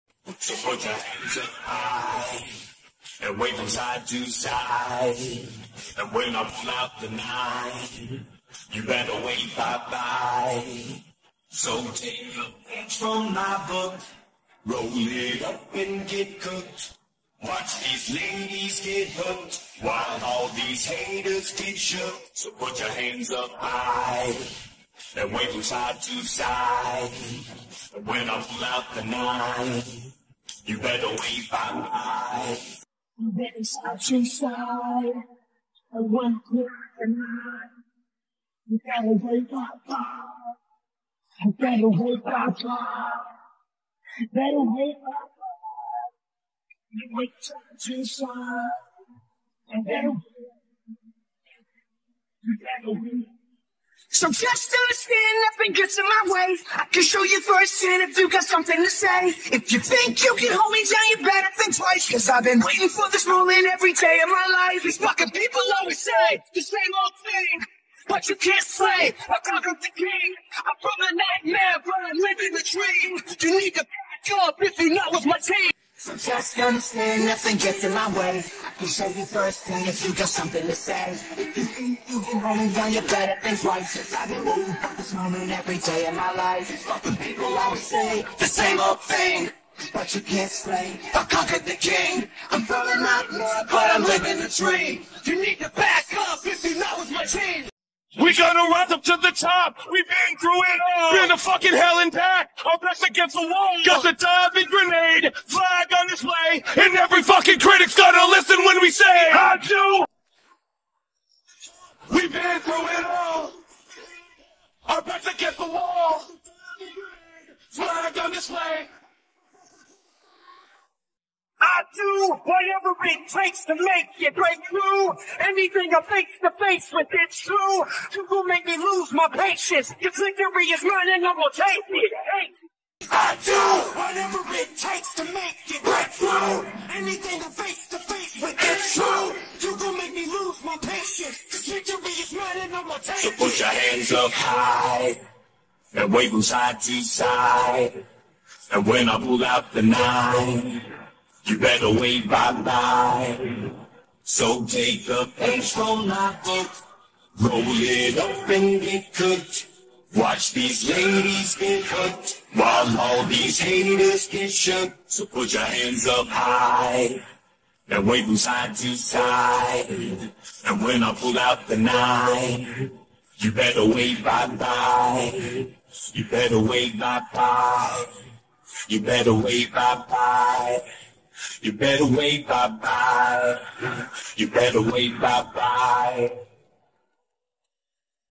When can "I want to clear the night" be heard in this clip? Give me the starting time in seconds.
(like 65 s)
35 s.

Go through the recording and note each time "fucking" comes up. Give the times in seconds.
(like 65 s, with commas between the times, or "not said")
64 s, 101 s, 107 s.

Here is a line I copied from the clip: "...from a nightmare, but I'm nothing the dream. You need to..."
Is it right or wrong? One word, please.
wrong.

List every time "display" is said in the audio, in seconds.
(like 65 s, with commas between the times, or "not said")
106 s, 118 s.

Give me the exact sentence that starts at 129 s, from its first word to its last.
Your victory is mine and I'm gonna take it.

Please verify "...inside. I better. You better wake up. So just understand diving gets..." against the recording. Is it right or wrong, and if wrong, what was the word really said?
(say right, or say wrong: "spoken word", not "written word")
wrong: "nothing", not "diving".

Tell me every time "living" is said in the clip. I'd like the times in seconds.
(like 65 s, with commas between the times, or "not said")
72 s, 94 s.